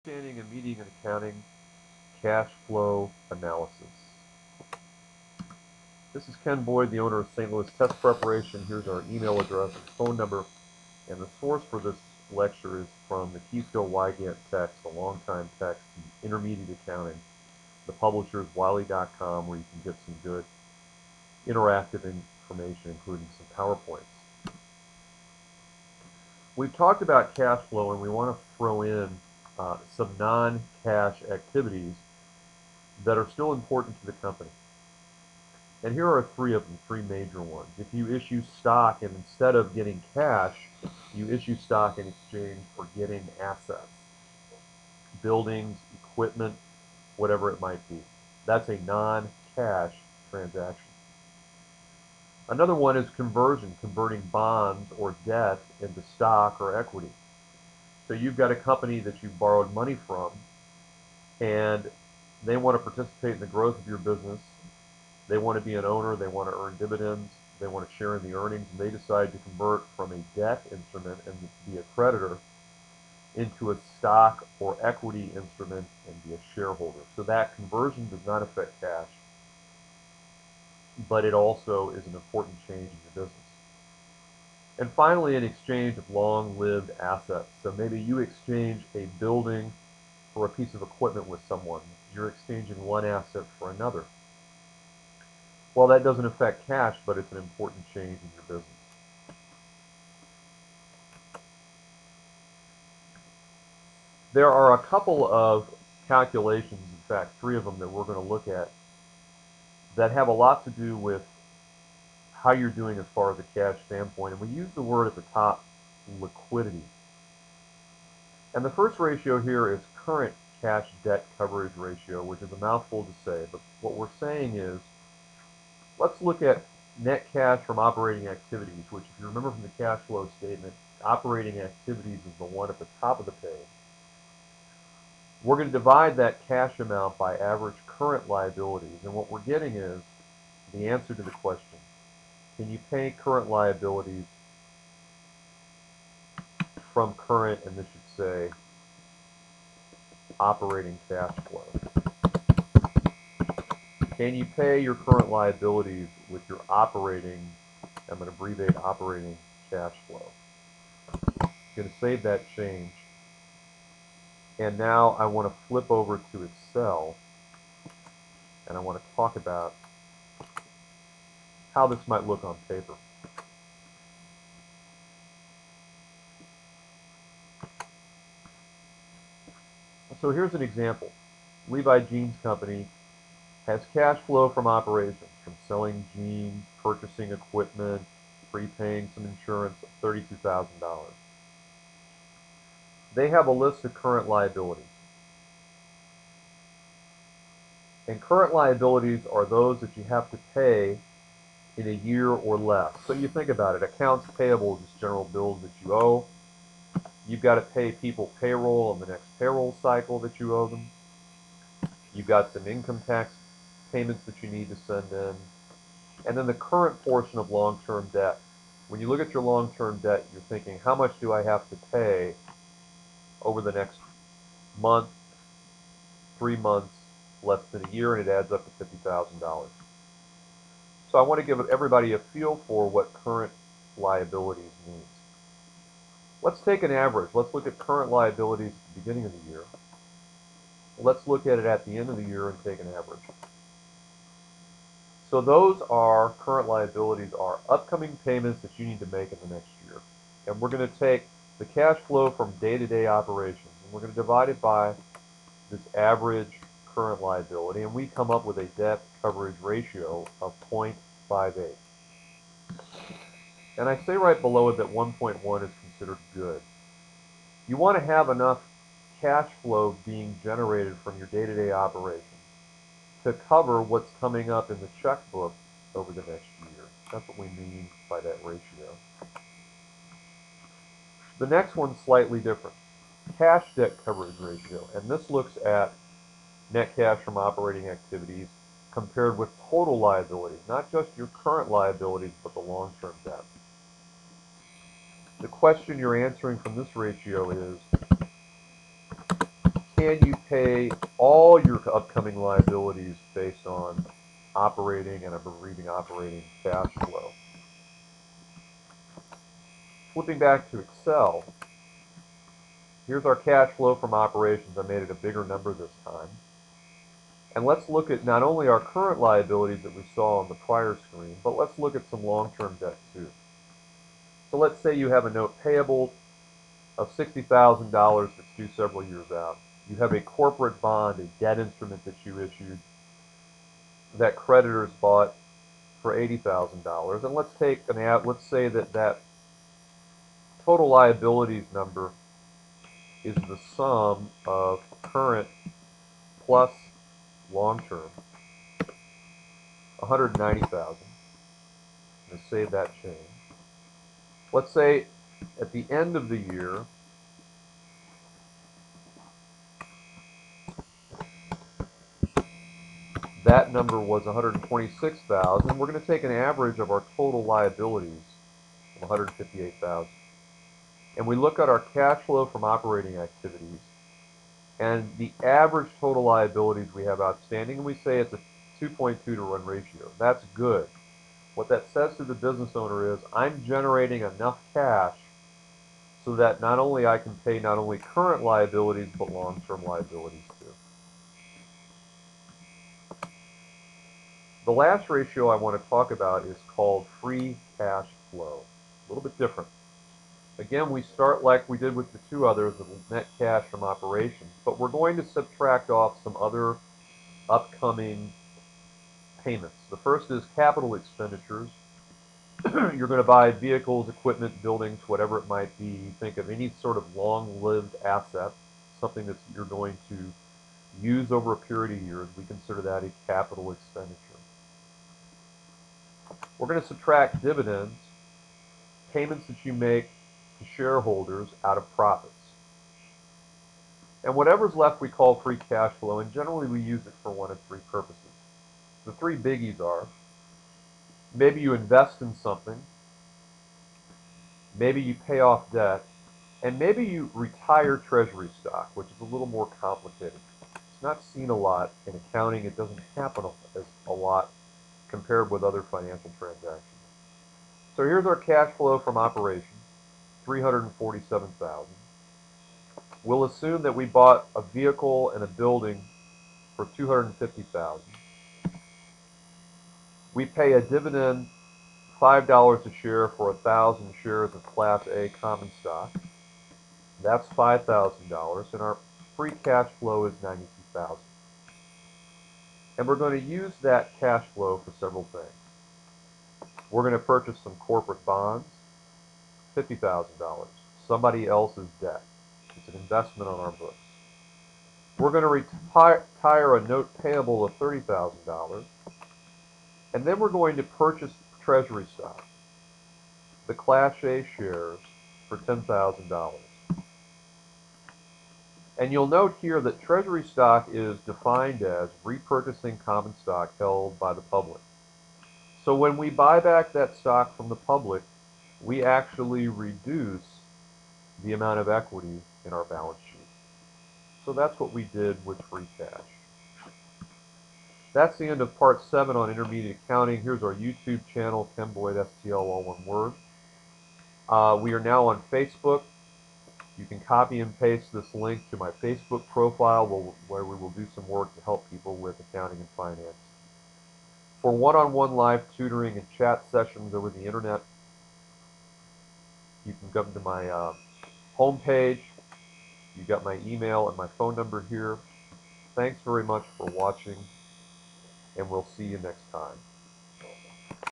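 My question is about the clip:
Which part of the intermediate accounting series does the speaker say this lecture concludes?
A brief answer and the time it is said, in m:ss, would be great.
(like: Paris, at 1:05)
7, at 8:48.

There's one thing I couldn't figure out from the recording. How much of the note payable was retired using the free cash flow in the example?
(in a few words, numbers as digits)
$30,000.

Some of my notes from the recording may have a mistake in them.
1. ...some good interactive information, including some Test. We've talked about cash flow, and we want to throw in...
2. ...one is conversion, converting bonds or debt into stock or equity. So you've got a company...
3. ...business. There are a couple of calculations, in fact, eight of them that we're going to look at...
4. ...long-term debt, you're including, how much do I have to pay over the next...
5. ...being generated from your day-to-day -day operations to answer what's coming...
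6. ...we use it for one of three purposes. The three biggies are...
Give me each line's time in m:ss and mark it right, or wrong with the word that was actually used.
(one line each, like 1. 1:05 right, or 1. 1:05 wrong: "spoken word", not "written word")
1. 0:20 wrong: "PowerPoints", not "Test"
2. 0:52 right
3. 1:38 wrong: "three", not "eight"
4. 3:39 wrong: "thinking", not "including"
5. 4:30 wrong: "cover", not "answer"
6. 7:16 right.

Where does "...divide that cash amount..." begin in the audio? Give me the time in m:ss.
2:15.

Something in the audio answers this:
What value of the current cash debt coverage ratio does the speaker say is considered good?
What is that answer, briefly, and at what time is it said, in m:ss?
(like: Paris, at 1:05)
1.1, at 4:24.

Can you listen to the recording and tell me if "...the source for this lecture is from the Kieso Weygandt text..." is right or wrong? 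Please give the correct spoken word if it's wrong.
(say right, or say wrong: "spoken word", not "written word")
right.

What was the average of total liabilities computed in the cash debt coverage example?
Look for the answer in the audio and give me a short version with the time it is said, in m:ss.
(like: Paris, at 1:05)
158,000, at 6:09.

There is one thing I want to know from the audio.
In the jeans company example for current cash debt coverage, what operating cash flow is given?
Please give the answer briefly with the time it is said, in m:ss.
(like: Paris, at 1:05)
$32,000, at 3:10.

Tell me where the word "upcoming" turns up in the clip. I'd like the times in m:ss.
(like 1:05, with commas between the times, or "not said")
4:07, 5:01, 6:47.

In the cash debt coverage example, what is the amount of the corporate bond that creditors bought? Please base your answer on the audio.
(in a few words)
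$80,000.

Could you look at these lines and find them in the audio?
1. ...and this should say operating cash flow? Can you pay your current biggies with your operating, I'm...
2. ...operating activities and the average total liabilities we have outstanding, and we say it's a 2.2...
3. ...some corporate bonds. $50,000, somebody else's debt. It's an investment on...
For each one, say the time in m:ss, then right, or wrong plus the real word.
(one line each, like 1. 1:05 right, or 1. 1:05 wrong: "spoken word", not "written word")
1. 2:27 wrong: "liabilities", not "biggies"
2. 6:12 right
3. 8:07 right.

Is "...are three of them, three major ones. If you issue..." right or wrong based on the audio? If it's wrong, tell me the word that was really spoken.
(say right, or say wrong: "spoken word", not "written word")
right.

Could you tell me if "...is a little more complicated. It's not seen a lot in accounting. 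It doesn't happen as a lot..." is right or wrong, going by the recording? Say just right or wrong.
right.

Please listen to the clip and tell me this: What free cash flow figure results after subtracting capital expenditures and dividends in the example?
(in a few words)
92,000.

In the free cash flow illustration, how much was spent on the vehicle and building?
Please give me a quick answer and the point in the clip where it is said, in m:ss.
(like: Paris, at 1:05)
250,000, at 7:46.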